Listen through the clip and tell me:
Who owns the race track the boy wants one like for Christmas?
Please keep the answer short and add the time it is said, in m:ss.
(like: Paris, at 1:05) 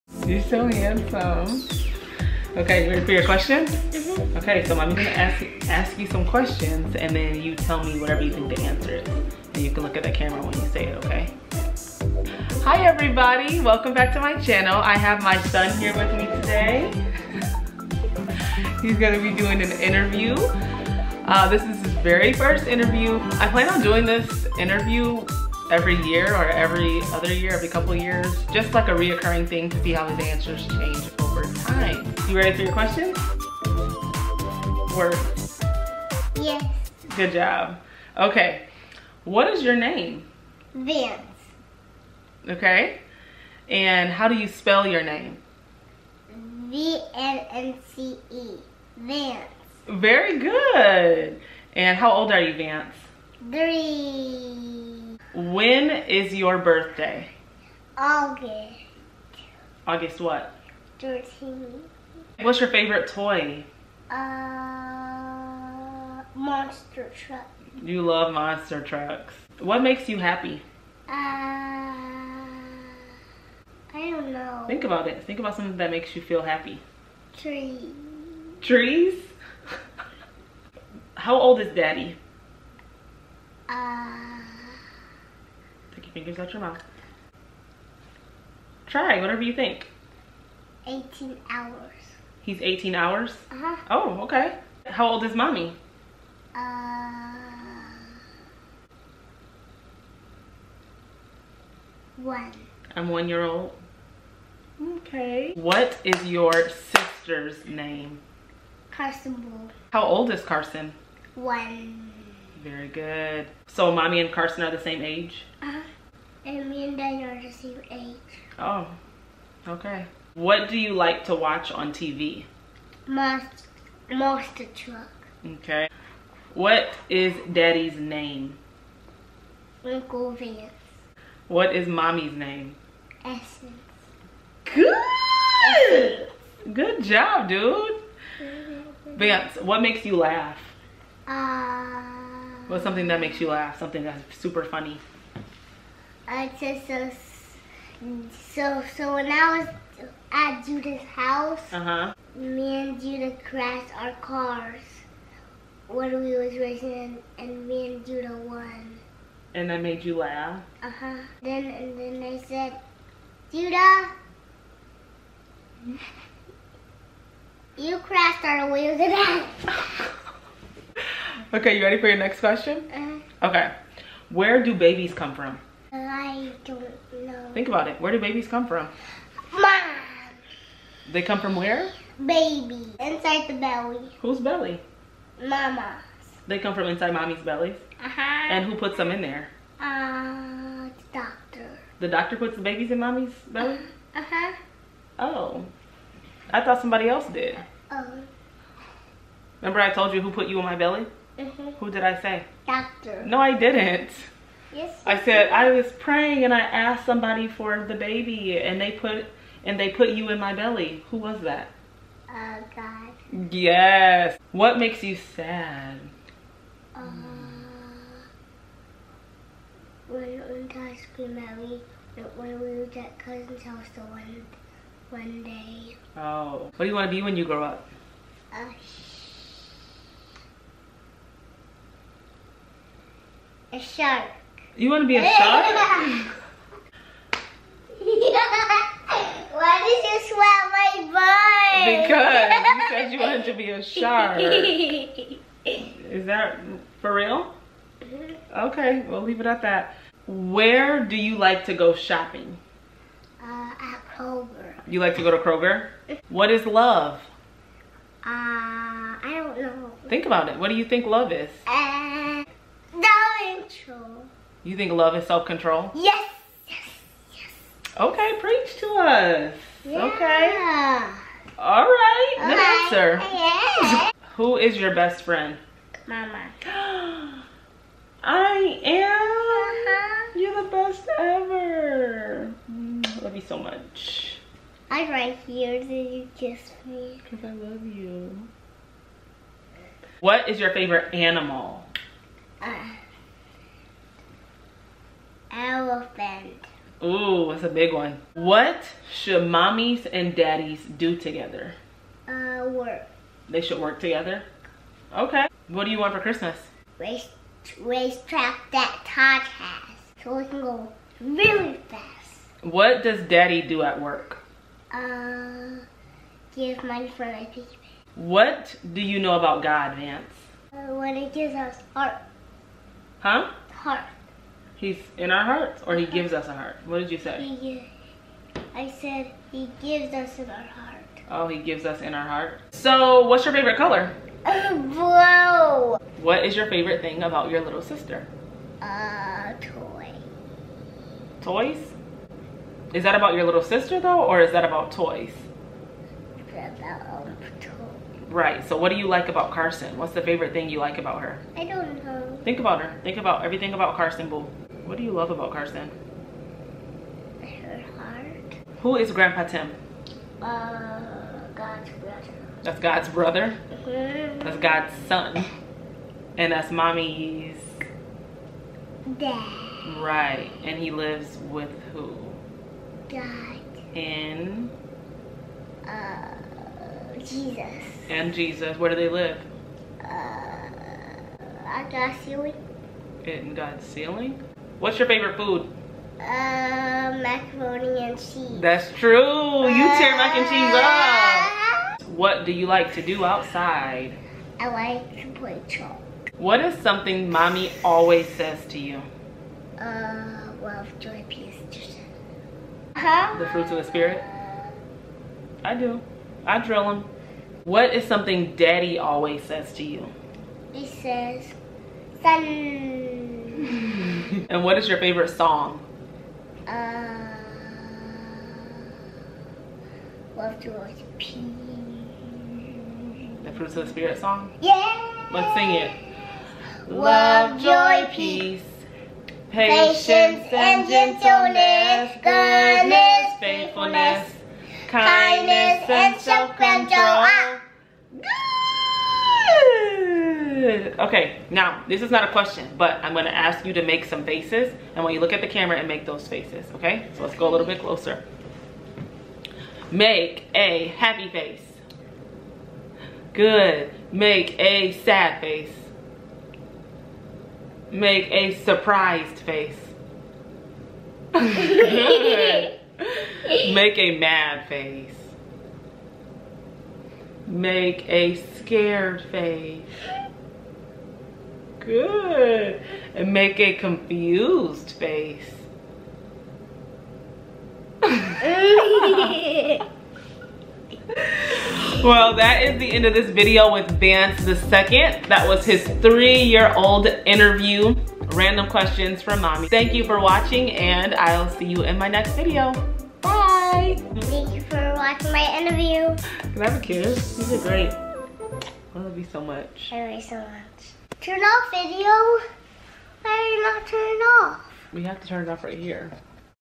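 Todd, at 5:09.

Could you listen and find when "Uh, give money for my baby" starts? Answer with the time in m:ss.
5:14.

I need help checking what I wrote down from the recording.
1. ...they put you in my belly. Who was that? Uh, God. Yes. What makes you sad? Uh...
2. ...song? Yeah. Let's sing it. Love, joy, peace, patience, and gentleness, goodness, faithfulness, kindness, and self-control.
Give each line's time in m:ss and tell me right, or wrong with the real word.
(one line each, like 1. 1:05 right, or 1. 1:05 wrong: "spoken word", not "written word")
1. 3:29 right
2. 7:04 right.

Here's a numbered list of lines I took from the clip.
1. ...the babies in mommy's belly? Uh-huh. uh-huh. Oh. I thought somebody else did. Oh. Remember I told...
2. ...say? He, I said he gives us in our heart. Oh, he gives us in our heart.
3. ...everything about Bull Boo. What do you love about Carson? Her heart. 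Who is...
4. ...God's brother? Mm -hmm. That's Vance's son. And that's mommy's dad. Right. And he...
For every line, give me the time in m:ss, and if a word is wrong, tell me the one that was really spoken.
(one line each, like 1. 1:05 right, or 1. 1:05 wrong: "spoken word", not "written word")
1. 3:12 right
2. 5:27 right
3. 5:53 wrong: "Carson", not "Bull"
4. 6:02 wrong: "God", not "Vance".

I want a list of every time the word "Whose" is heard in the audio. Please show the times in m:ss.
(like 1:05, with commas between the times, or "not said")
3:04.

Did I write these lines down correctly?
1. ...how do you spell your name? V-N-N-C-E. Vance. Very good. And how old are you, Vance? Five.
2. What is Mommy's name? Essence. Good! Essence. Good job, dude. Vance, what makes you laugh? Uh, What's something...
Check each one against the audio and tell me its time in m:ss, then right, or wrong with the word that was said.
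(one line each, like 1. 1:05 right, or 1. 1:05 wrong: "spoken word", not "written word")
1. 0:44 wrong: "Three", not "Five"
2. 2:11 right.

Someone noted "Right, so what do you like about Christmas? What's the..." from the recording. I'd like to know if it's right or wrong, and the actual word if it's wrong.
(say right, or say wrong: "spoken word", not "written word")
wrong: "Carson", not "Christmas".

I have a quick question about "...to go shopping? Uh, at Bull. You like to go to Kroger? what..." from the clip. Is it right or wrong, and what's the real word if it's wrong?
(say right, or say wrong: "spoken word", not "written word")
wrong: "Kroger", not "Bull".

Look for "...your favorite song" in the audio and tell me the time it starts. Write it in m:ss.
6:54.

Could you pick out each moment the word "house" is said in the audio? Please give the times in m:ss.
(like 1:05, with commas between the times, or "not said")
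2:31, 3:43.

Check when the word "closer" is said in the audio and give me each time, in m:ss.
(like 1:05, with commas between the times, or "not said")
7:27.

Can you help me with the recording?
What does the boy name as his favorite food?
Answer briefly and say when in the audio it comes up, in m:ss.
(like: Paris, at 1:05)
Macaroni and cheese, at 6:26.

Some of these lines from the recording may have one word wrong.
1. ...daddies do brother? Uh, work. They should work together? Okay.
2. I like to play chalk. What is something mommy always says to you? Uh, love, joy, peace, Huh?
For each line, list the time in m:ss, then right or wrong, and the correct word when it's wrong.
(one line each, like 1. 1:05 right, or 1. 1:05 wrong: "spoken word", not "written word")
1. 5:00 wrong: "together", not "brother"
2. 6:34 right.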